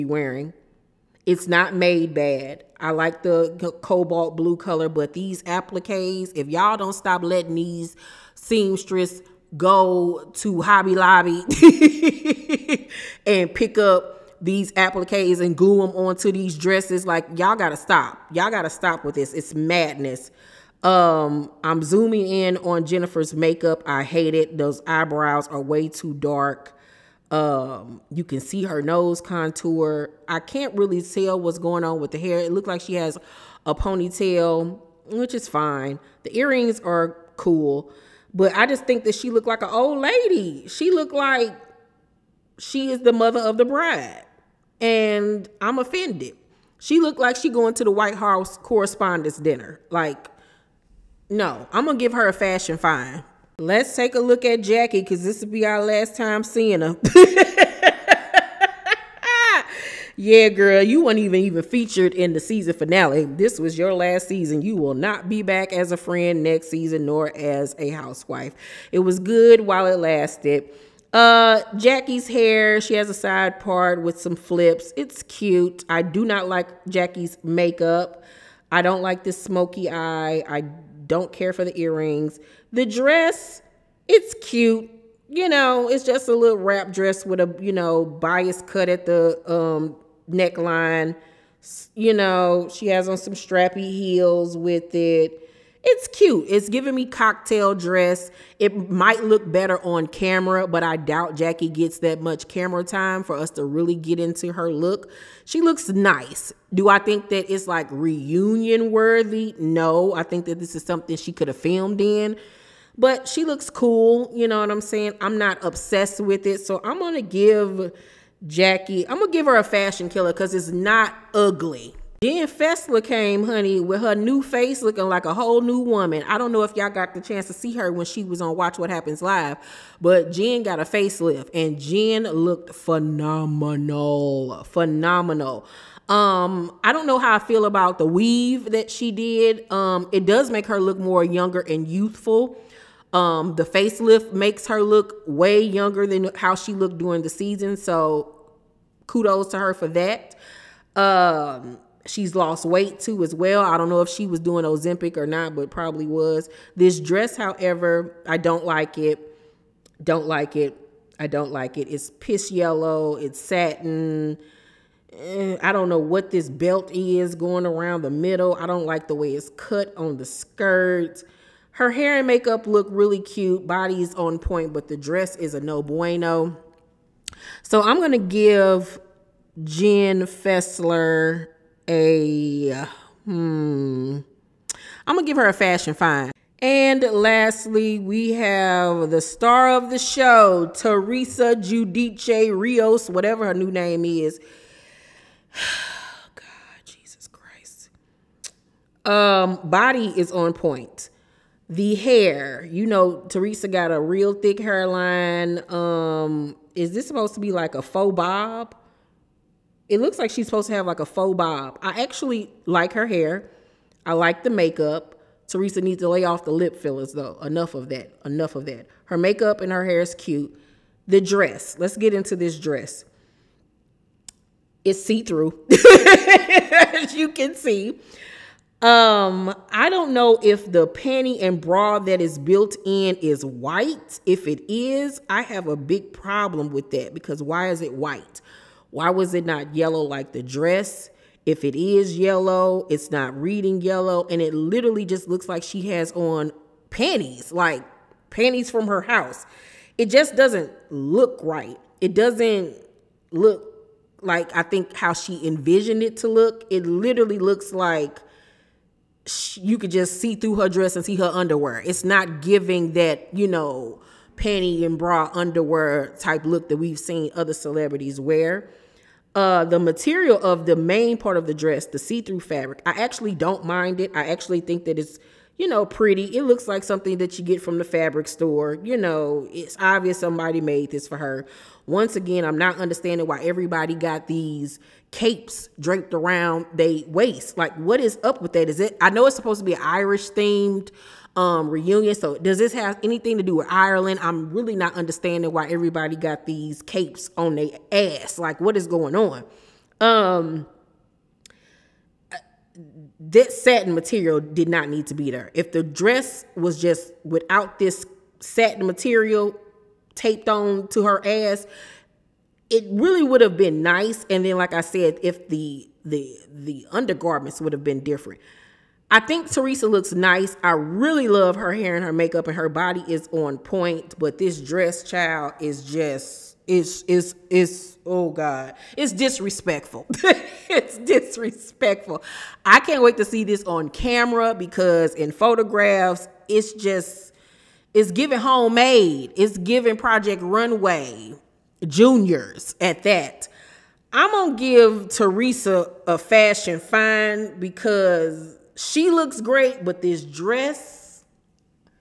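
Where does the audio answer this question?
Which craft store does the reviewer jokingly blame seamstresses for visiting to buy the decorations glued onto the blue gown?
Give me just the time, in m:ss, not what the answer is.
0:10.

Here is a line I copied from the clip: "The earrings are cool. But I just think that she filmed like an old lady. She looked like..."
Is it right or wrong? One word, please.
wrong.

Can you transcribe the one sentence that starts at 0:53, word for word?
Let's take a look at Jackie because this will be our last time seeing her.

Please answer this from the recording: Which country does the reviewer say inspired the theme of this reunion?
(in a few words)
Ireland.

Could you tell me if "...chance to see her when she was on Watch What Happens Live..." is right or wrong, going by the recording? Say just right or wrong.
right.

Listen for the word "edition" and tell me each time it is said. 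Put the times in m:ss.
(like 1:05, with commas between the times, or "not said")
not said.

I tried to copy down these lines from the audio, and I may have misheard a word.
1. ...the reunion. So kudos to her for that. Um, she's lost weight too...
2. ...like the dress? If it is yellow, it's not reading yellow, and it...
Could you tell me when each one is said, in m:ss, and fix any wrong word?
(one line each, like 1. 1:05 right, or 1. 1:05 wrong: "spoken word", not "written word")
1. 2:27 wrong: "season", not "reunion"
2. 4:00 right.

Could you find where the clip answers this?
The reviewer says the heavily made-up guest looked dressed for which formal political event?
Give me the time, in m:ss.
0:47.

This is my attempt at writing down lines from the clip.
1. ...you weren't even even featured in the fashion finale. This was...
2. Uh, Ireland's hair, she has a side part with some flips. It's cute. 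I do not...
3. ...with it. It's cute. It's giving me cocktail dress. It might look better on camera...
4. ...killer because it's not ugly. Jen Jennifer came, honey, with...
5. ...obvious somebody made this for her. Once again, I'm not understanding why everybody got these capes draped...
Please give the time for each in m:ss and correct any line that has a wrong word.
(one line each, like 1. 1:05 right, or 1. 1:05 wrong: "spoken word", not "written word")
1. 1:00 wrong: "season", not "fashion"
2. 1:11 wrong: "Jackie", not "Ireland"
3. 1:34 right
4. 2:00 wrong: "Fessler", not "Jennifer"
5. 4:39 right.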